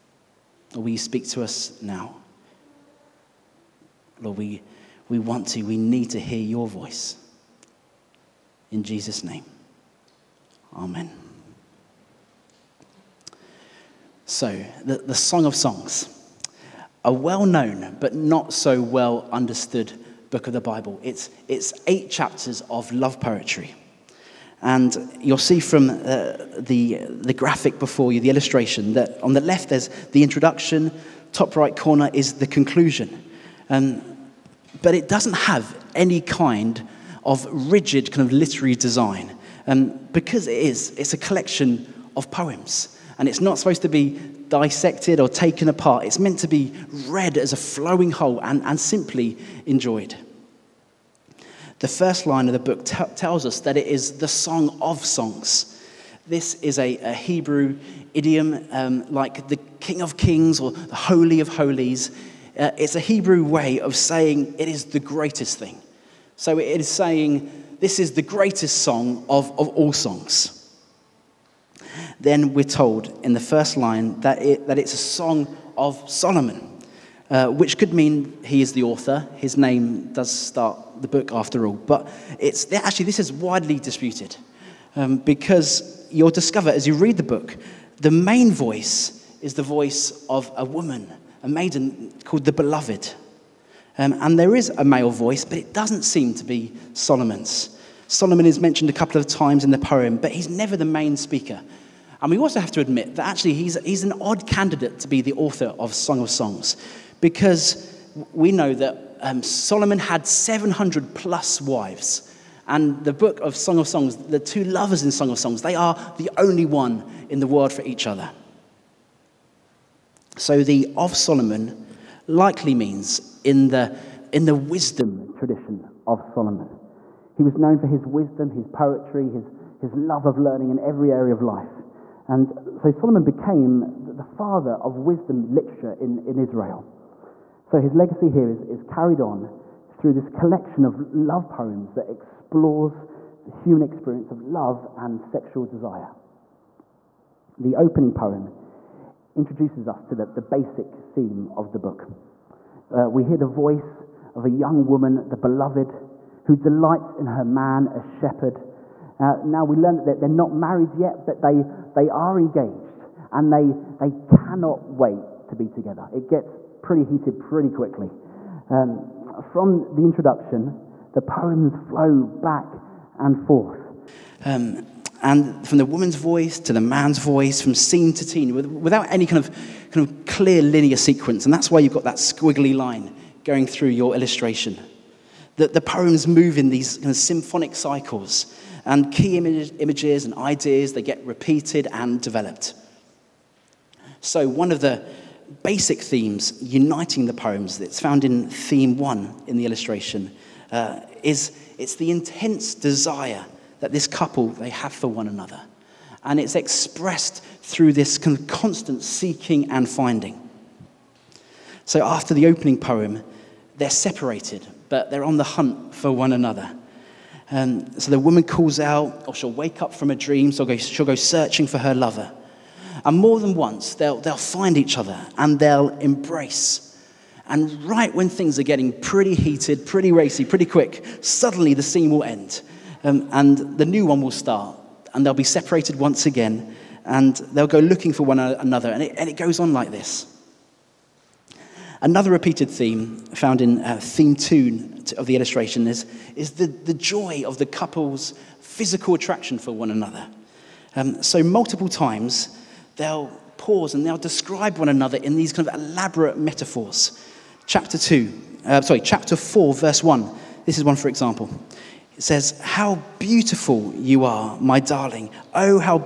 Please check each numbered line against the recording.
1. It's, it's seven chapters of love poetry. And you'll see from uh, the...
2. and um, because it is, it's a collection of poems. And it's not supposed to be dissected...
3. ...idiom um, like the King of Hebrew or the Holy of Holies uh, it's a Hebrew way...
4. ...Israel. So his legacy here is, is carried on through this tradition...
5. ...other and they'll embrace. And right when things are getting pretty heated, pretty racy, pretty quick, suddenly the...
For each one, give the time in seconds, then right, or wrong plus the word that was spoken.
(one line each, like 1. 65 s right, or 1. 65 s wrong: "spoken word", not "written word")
1. 21 s wrong: "eight", not "seven"
2. 39 s right
3. 58 s wrong: "Kings", not "Hebrew"
4. 136 s wrong: "collection", not "tradition"
5. 224 s right.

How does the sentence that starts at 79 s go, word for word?
His name does start the book after all.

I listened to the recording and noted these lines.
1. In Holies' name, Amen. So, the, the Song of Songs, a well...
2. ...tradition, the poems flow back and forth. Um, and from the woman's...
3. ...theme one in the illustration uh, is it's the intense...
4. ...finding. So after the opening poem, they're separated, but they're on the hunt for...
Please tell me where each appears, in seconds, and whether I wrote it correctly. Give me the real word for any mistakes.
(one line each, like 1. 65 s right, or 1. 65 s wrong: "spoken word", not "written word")
1. 8 s wrong: "Jesus", not "Holies"
2. 170 s wrong: "introduction", not "tradition"
3. 198 s right
4. 209 s right.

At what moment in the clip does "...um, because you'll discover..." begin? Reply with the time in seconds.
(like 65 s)
84 s.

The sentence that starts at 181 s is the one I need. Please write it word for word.
And that's why you've got that squiggly line going through your illustration.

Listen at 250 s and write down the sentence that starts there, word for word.
Um, so, multiple times, they'll pause and they'll describe one another in these kind of elaborate metaphors.